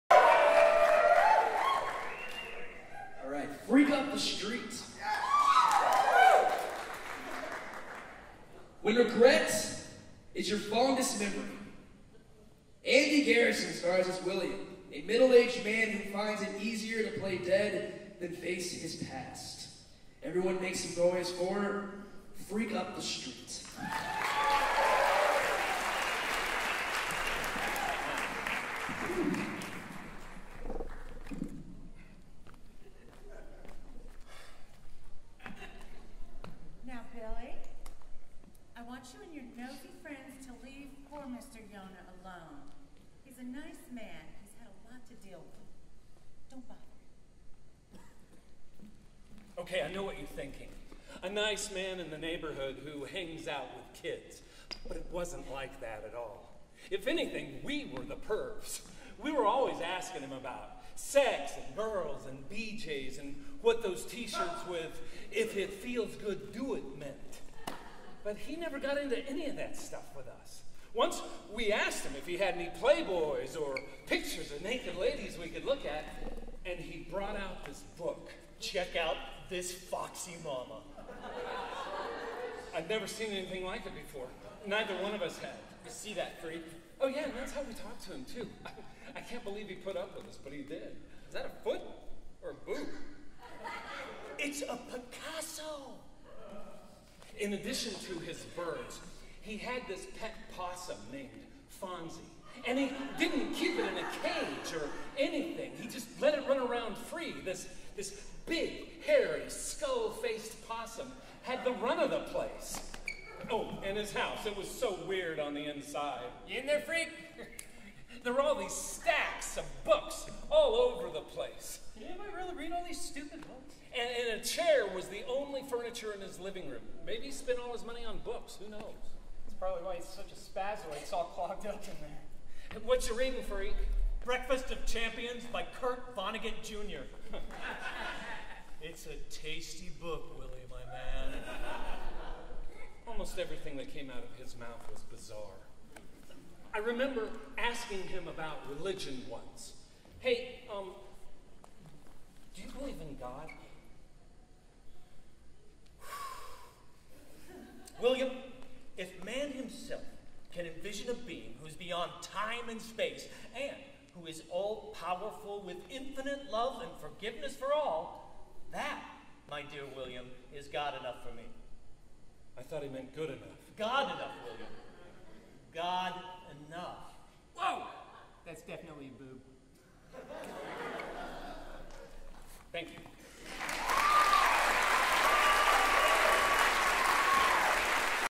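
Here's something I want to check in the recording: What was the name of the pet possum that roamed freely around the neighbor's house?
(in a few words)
Fonzie.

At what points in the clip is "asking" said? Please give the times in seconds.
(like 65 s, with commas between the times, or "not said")
59 s, 147 s.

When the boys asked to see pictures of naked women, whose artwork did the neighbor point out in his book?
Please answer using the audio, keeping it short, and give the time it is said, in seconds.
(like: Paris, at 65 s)
Picasso, at 94 s.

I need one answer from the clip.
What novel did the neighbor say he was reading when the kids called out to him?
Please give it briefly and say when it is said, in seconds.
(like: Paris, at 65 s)
Breakfast of Champions, at 134 s.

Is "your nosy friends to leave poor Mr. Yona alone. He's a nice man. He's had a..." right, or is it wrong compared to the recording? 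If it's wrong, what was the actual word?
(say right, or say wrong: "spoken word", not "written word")
right.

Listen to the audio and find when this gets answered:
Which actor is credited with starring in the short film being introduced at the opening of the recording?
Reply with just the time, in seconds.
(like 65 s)
12 s.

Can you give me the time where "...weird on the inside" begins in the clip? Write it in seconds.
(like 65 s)
115 s.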